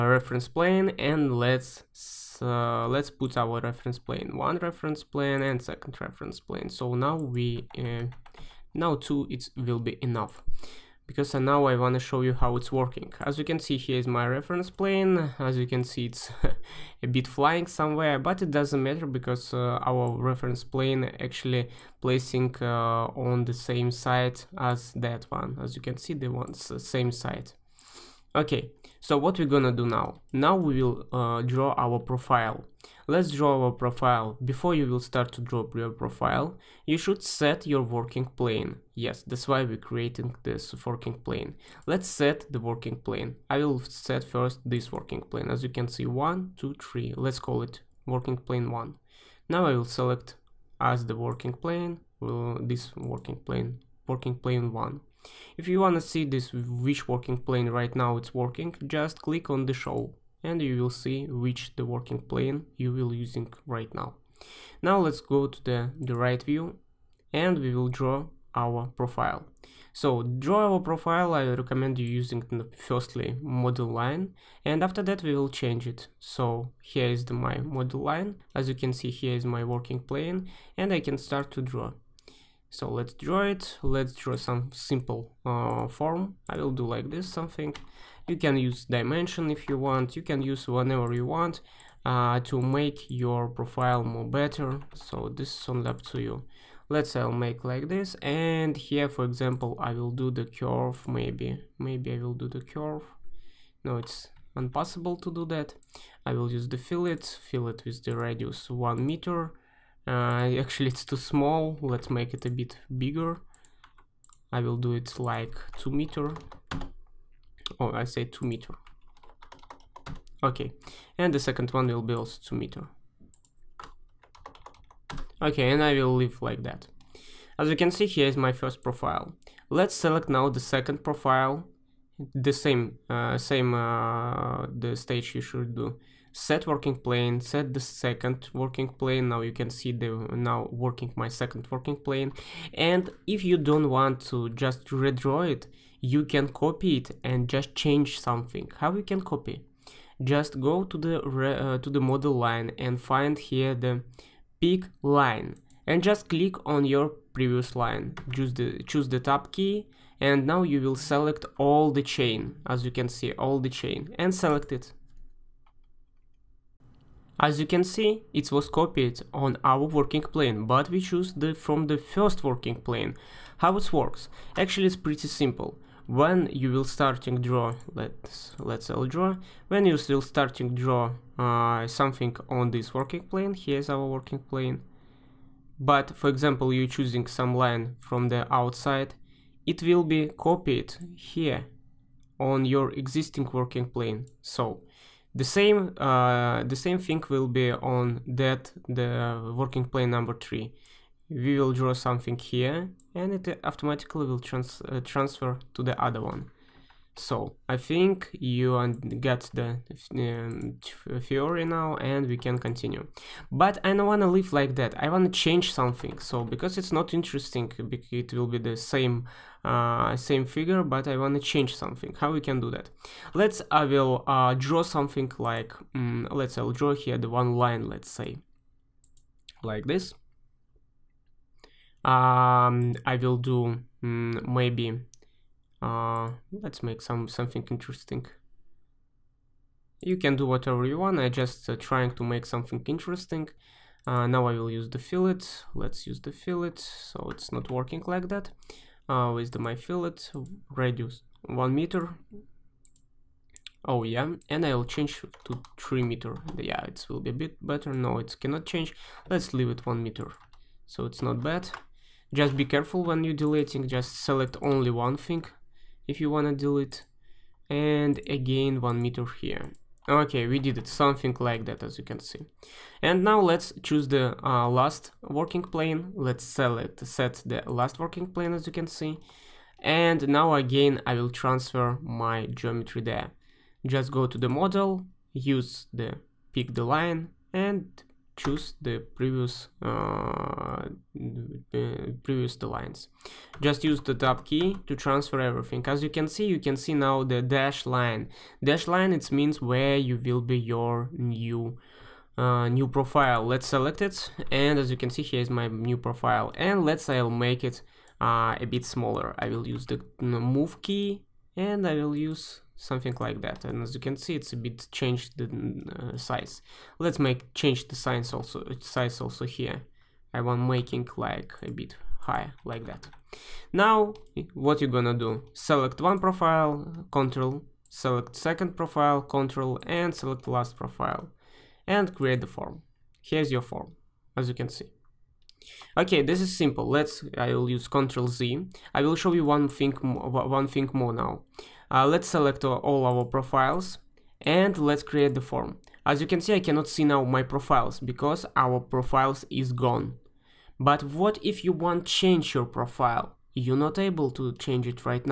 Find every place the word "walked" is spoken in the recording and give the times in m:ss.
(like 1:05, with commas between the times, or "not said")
not said.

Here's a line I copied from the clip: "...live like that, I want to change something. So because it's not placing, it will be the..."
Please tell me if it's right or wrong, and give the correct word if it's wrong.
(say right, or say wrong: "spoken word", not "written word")
wrong: "interesting", not "placing".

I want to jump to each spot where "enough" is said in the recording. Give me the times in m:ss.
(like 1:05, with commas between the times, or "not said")
0:10.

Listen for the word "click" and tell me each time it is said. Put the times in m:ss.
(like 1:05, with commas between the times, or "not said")
0:59, 2:36.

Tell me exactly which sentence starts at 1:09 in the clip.
So draw our profile, I recommend you using firstly model line and after that we will change it.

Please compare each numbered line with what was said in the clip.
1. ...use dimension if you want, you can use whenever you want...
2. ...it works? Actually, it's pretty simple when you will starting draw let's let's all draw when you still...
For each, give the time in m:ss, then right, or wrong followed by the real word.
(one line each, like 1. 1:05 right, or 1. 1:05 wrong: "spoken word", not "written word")
1. 1:28 right
2. 2:53 right.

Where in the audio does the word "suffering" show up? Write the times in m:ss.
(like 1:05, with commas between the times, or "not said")
not said.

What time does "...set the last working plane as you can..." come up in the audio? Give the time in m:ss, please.
4:37.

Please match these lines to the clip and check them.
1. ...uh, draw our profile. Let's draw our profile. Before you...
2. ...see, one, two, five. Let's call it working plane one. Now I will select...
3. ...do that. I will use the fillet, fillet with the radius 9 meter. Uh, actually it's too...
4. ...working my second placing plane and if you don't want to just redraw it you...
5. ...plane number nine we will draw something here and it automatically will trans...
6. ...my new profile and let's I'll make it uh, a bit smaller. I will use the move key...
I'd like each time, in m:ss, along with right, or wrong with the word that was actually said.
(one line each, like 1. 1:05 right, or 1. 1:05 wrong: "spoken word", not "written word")
1. 0:31 right
2. 0:45 wrong: "three", not "five"
3. 1:45 wrong: "1", not "9"
4. 2:20 wrong: "working", not "placing"
5. 3:19 wrong: "three", not "nine"
6. 5:05 right.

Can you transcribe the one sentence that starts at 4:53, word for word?
Just use the tab key to transfer everything.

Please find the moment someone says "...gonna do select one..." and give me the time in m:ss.
5:24.